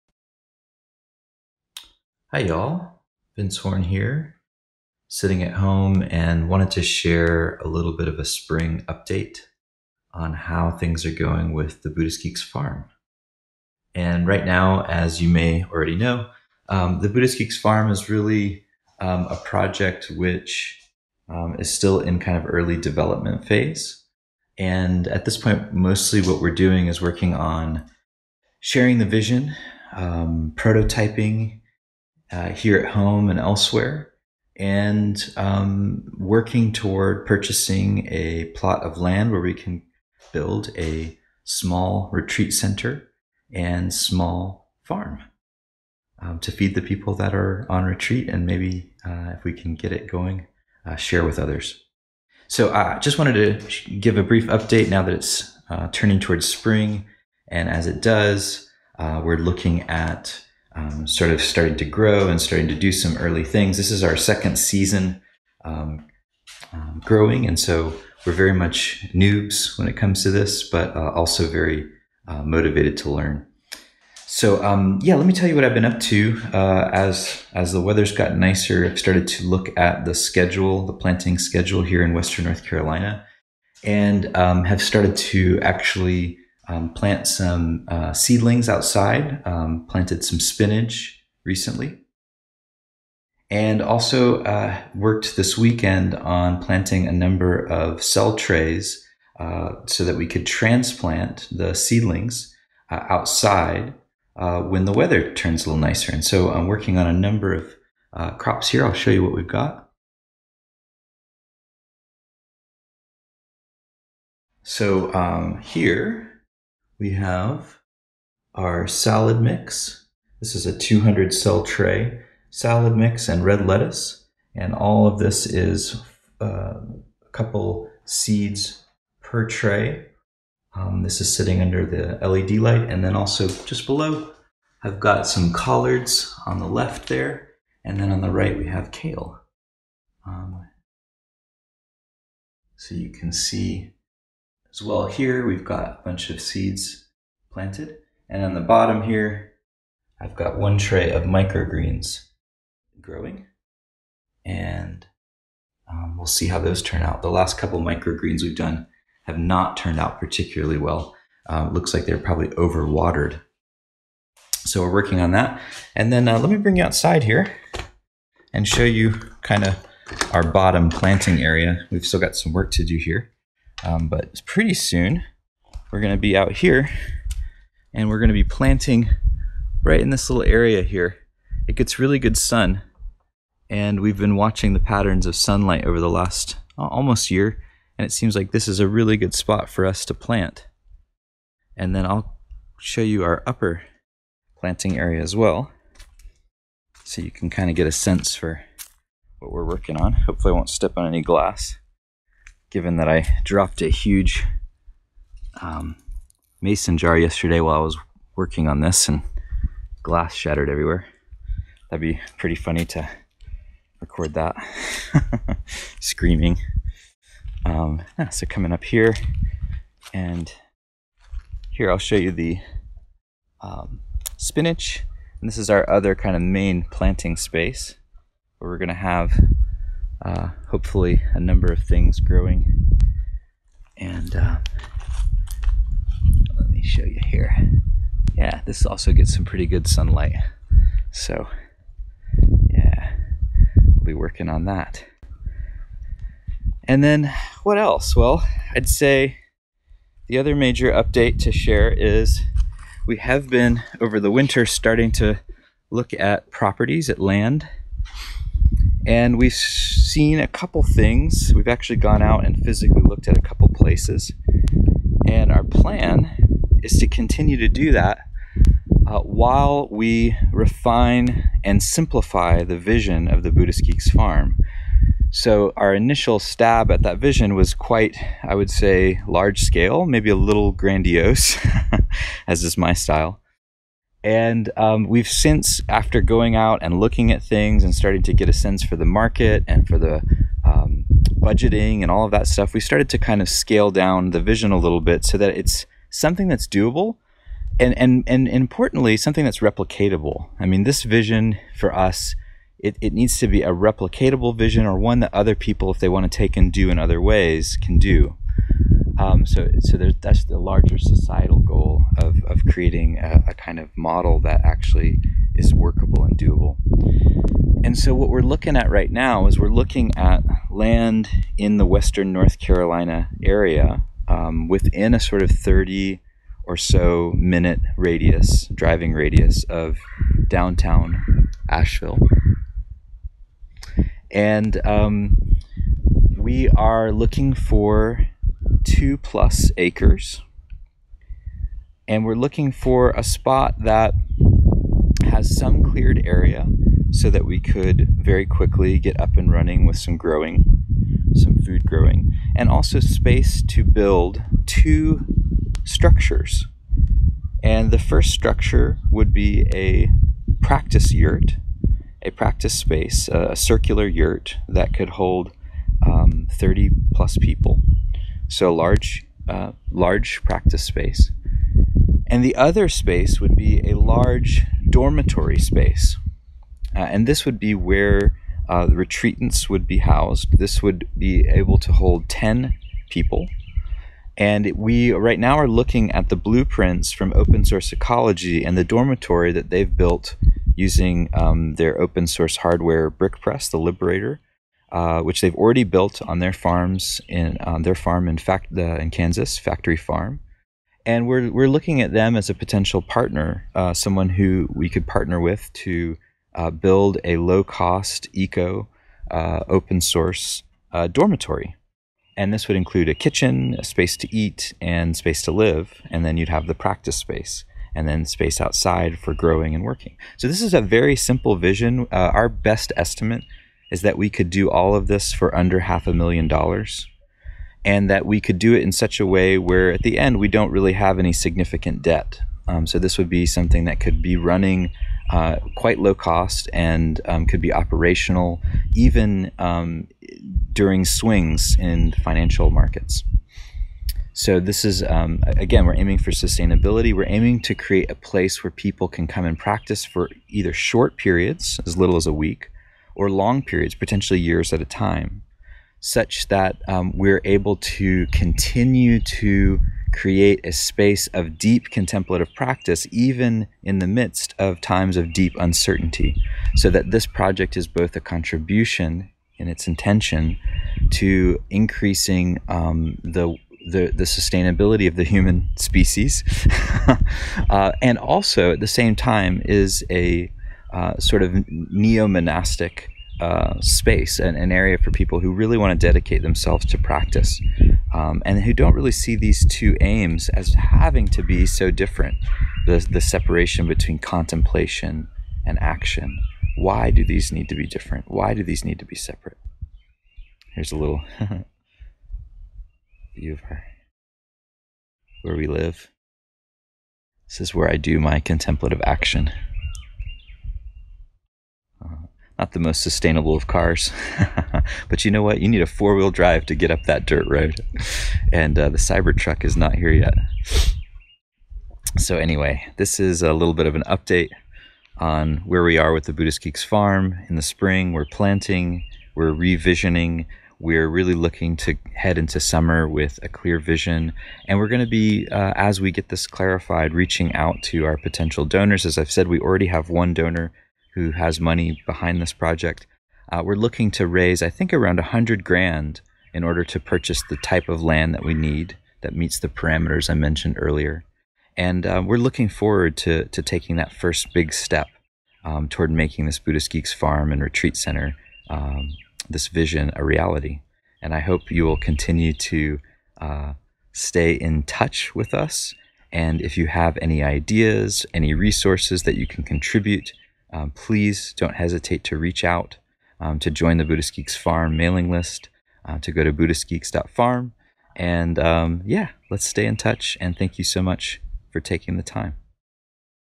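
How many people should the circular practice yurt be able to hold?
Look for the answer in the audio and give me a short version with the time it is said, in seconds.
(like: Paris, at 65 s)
30 plus, at 366 s.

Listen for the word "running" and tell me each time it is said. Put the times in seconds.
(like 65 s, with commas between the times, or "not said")
349 s, 434 s.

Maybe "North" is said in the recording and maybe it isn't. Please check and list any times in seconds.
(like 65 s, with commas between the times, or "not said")
82 s, 322 s.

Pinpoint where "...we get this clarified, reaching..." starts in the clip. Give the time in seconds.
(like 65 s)
536 s.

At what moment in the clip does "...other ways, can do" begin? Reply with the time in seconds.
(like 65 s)
306 s.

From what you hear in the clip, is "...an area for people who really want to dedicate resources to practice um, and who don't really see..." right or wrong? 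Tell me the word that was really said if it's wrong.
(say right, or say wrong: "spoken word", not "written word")
wrong: "themselves", not "resources".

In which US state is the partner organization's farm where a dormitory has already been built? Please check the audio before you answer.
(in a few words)
Kansas.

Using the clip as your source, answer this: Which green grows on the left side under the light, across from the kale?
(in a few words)
Collards.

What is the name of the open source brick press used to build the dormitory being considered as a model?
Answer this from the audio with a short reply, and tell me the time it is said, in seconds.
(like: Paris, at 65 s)
The Liberator, at 393 s.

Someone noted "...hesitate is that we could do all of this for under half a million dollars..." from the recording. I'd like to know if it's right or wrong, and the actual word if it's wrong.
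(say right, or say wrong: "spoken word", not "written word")
wrong: "estimate", not "hesitate".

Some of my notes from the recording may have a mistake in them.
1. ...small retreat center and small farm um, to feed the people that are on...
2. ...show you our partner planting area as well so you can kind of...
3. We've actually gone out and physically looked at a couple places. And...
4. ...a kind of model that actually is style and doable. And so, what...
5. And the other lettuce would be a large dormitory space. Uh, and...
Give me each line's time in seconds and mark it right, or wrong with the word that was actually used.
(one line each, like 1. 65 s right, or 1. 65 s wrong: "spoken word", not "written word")
1. 41 s right
2. 192 s wrong: "upper", not "partner"
3. 261 s right
4. 313 s wrong: "workable", not "style"
5. 372 s wrong: "space", not "lettuce".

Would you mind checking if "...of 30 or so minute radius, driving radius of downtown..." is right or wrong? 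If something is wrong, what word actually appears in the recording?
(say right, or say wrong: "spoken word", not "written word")
right.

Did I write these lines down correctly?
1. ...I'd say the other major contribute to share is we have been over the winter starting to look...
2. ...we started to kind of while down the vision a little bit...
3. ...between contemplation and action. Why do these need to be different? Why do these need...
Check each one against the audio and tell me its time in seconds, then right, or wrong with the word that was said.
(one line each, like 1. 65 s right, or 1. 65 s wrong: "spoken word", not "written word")
1. 248 s wrong: "update", not "contribute"
2. 292 s wrong: "scale", not "while"
3. 493 s right.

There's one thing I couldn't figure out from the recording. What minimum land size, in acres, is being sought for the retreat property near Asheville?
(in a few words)
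2 plus acres.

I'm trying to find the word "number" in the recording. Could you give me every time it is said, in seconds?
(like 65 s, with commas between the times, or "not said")
97 s, 107 s, 231 s.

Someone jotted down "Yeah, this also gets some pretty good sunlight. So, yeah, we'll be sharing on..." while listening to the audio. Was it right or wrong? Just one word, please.
wrong.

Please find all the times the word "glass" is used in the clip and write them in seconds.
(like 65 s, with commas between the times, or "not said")
201 s, 210 s.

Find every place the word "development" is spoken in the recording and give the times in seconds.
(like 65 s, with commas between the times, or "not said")
22 s.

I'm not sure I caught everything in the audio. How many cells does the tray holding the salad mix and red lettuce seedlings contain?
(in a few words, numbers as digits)
200.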